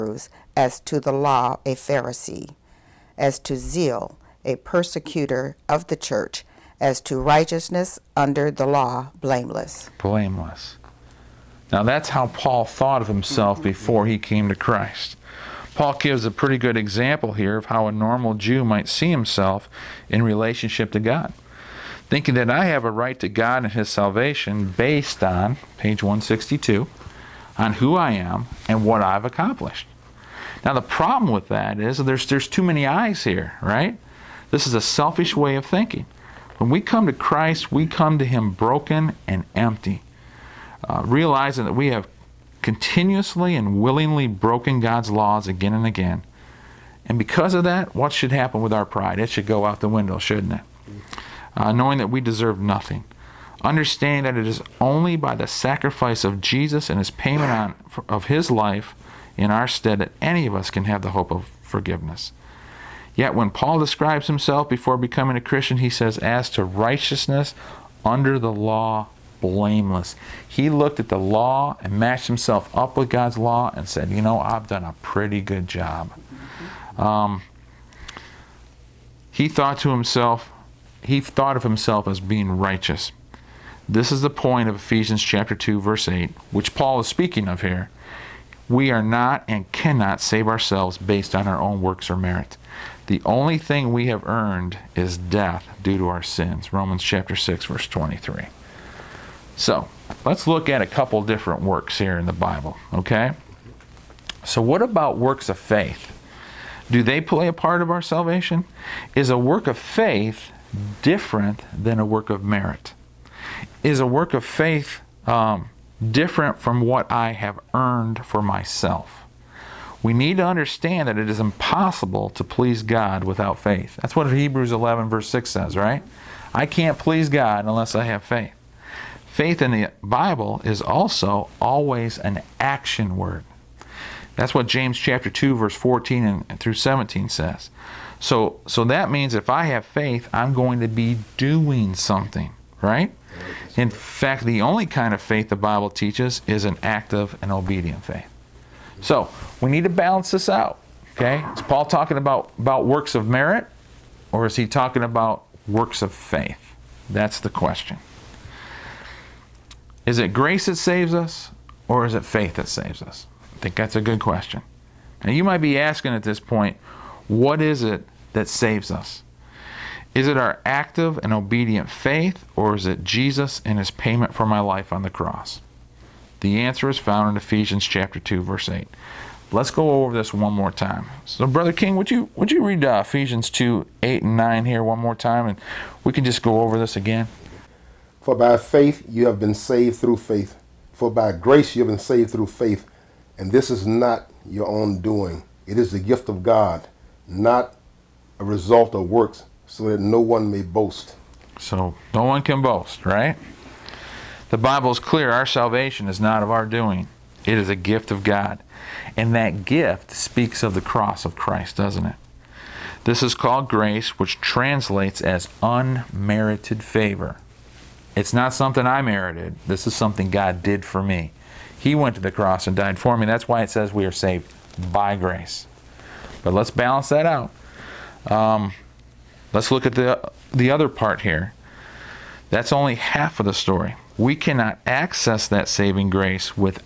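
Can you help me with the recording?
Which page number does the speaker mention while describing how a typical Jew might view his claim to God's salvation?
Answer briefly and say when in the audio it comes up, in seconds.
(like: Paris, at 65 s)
162, at 25 s.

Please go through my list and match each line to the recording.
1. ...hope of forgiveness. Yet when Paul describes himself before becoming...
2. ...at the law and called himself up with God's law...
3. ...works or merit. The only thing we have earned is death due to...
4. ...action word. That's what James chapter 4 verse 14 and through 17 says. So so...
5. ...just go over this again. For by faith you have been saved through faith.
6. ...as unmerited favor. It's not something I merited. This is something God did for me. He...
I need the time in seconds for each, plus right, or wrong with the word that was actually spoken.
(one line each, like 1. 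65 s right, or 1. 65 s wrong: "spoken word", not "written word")
1. 61 s right
2. 70 s wrong: "matched", not "called"
3. 91 s right
4. 132 s wrong: "2", not "4"
5. 186 s right
6. 215 s right.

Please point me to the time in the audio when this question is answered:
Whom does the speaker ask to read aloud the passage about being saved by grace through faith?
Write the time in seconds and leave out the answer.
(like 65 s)
181 s.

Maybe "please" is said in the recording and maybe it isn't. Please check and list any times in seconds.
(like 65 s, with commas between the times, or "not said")
122 s, 126 s.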